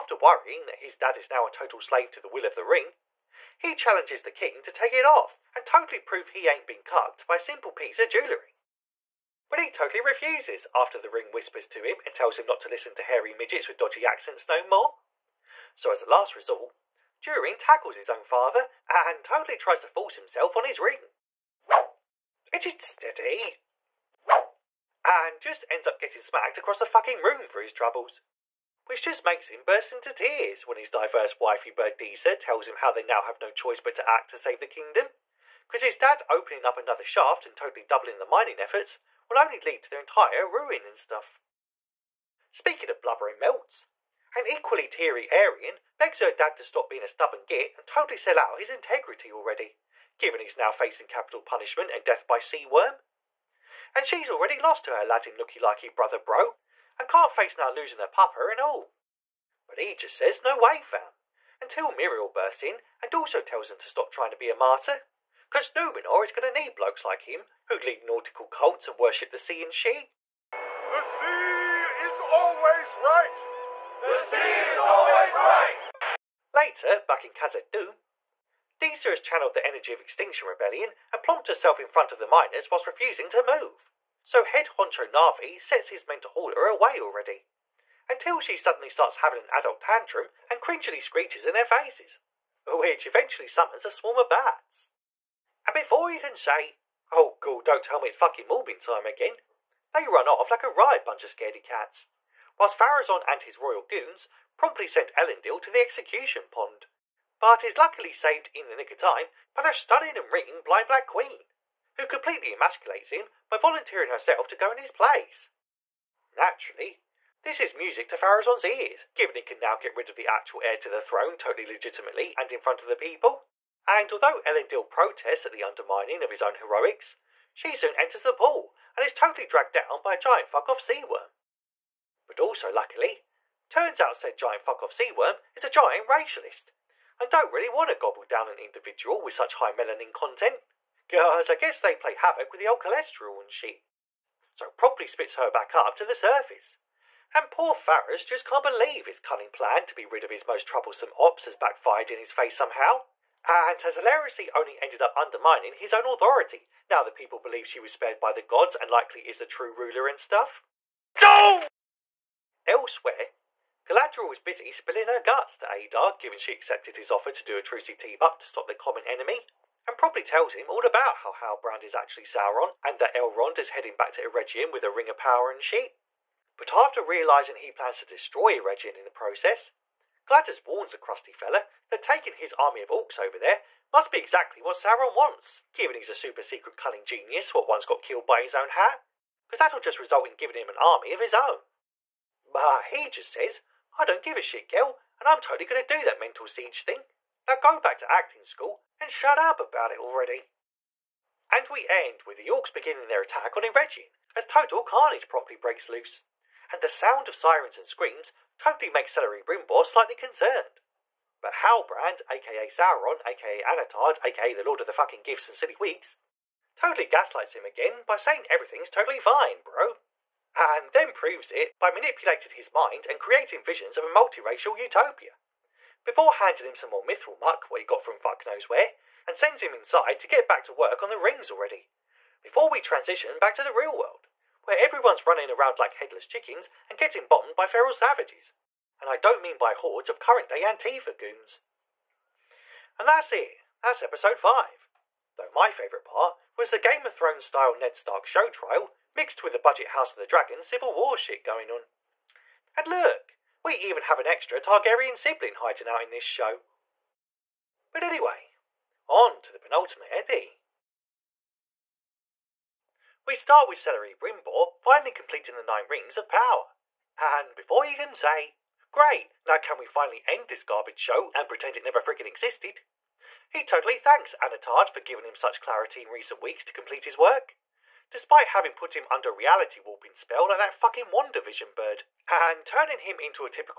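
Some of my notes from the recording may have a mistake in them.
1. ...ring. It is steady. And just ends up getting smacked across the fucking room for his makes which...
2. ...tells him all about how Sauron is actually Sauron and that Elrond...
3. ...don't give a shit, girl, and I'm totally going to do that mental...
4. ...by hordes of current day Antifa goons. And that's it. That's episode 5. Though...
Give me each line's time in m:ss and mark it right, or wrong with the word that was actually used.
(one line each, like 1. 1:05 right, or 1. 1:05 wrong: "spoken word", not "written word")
1. 0:20 wrong: "troubles", not "makes"
2. 2:50 wrong: "Halbrand", not "Sauron"
3. 3:14 right
4. 3:59 right.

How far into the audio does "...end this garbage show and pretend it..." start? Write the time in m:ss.
4:30.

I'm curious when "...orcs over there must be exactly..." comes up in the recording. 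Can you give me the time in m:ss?
3:02.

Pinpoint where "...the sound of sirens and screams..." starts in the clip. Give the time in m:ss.
3:26.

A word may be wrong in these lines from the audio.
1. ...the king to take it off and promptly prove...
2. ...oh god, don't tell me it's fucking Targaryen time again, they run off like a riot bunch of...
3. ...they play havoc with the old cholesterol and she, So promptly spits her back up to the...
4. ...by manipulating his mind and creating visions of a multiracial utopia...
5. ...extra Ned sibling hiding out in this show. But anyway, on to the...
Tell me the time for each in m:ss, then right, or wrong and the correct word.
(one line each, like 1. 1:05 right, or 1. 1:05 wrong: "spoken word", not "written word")
1. 0:04 wrong: "totally", not "promptly"
2. 1:37 wrong: "Morbin", not "Targaryen"
3. 2:21 right
4. 3:41 right
5. 4:14 wrong: "Targaryen", not "Ned".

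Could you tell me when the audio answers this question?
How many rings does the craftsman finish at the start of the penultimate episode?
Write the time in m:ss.
4:25.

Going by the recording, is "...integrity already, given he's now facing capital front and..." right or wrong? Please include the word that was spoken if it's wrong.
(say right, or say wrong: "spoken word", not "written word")
wrong: "punishment", not "front".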